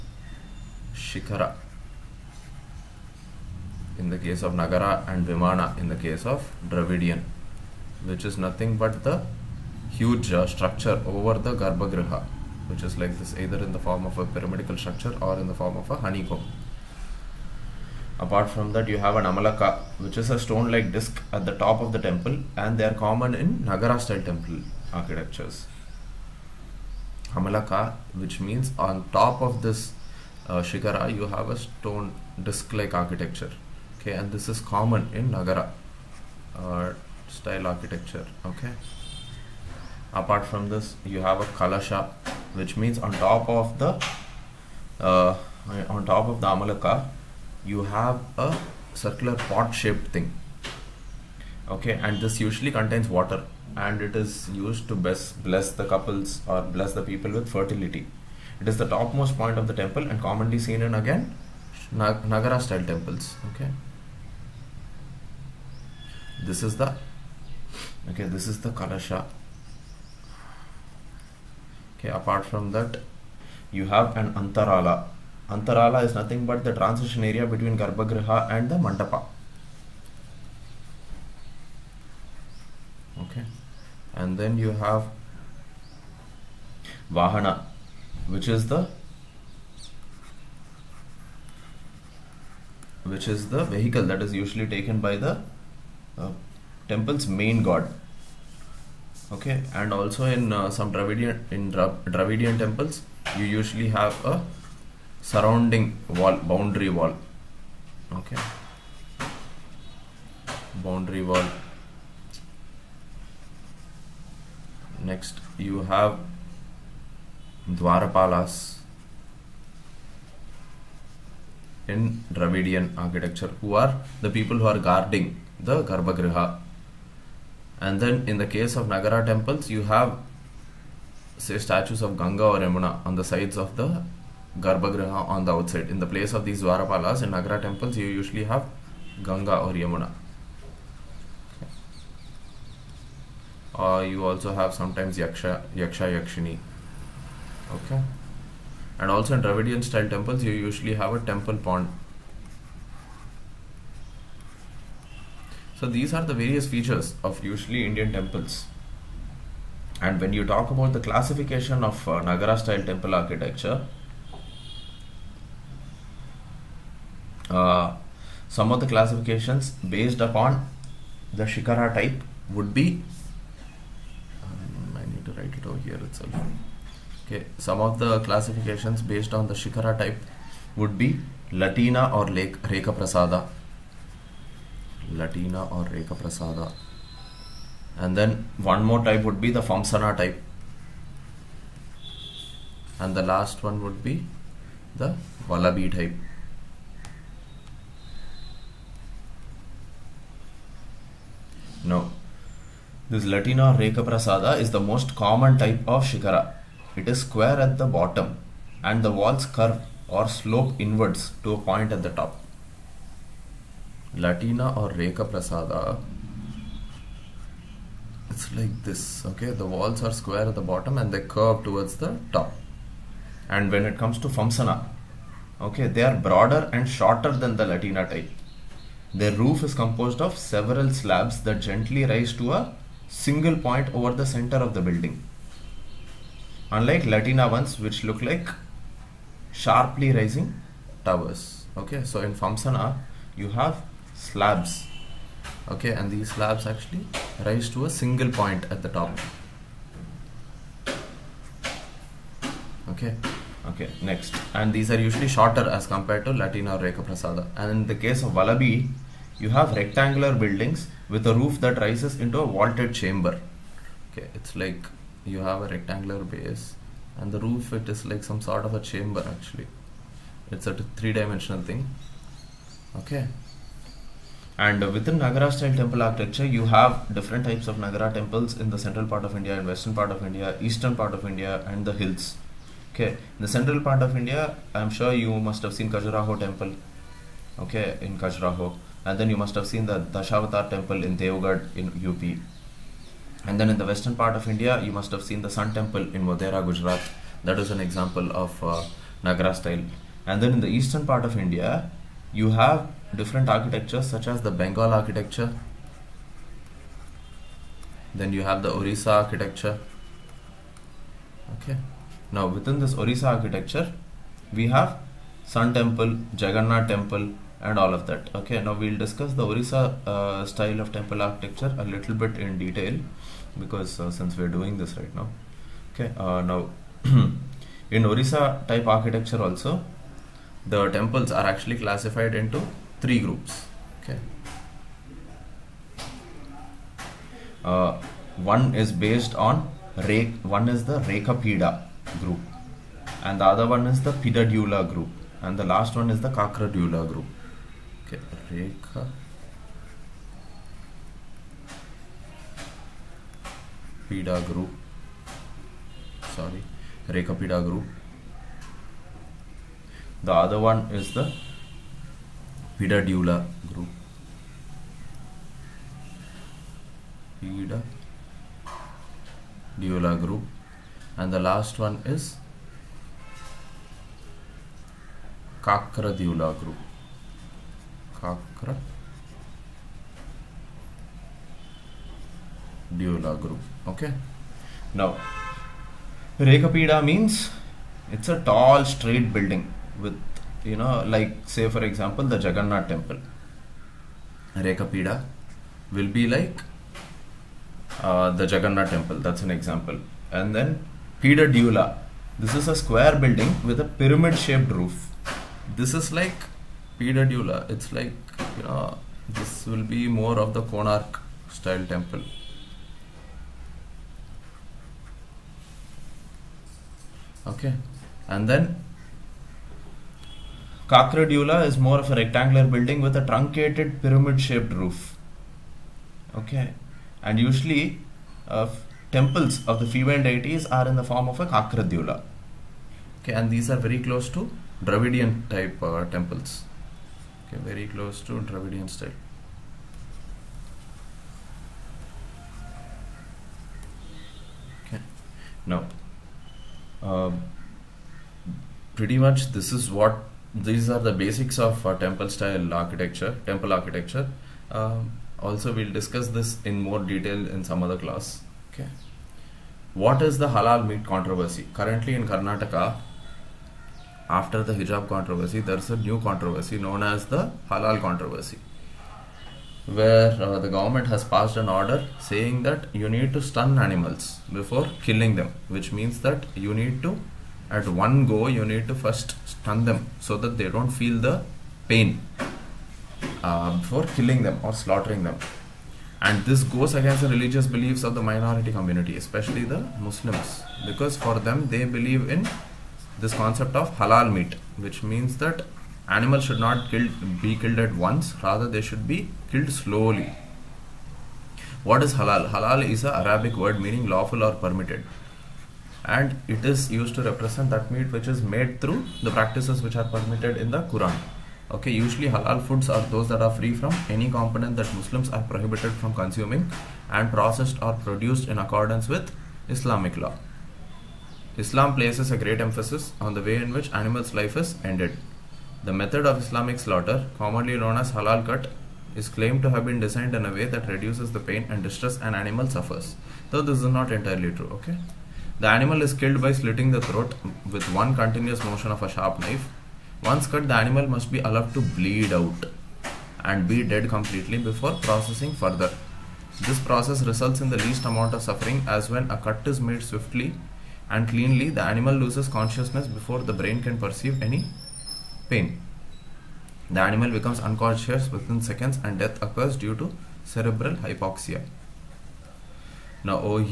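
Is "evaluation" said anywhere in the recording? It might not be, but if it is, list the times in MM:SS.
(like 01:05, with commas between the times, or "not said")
not said.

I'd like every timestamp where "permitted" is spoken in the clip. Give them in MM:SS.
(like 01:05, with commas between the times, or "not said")
08:24, 08:30.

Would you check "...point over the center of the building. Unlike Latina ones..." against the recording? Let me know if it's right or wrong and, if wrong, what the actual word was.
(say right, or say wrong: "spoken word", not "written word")
right.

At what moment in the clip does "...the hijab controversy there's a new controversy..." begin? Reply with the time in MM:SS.
07:44.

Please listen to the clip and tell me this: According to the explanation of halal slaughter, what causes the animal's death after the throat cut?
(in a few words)
cerebral hypoxia.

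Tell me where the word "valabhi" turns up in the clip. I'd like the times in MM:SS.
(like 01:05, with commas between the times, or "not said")
03:15, 04:18.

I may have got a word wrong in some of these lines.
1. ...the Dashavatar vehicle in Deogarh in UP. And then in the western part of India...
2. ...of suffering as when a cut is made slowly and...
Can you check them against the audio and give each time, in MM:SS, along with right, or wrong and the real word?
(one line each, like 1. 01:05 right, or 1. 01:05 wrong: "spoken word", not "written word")
1. 04:49 wrong: "temple", not "vehicle"
2. 09:08 wrong: "swiftly", not "slowly".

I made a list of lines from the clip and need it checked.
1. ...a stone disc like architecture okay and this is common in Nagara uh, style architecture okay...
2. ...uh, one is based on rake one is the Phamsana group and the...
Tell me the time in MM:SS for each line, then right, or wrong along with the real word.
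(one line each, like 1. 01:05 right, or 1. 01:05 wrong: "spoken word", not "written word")
1. 00:31 right
2. 05:37 wrong: "Rekapida", not "Phamsana".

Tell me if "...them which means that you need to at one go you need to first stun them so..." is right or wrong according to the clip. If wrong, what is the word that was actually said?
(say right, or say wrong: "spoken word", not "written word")
right.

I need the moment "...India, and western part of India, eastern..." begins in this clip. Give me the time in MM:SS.
04:39.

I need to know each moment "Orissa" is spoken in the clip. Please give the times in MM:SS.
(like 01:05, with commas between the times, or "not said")
05:08, 05:12, 05:19, 05:28.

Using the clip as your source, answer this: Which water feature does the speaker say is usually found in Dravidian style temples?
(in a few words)
temple pond.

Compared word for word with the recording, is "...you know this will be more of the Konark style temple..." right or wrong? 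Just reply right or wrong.
right.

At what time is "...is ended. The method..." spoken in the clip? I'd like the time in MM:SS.
08:44.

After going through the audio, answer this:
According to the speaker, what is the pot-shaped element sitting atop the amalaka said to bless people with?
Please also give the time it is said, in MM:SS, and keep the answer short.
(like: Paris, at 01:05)
fertility, at 00:57.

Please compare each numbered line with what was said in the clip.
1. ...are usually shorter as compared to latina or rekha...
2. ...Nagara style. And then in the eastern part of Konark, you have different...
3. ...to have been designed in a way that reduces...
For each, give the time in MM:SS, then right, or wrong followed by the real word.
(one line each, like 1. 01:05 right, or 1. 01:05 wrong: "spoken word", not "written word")
1. 04:14 right
2. 04:59 wrong: "India", not "Konark"
3. 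08:49 right.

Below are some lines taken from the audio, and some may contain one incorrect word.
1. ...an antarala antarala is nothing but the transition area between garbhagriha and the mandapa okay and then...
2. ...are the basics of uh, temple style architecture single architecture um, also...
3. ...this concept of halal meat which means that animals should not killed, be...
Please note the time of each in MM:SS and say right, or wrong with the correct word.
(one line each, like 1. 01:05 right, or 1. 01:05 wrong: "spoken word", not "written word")
1. 01:14 right
2. 07:30 wrong: "temple", not "single"
3. 08:13 right.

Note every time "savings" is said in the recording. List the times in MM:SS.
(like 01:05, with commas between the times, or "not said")
not said.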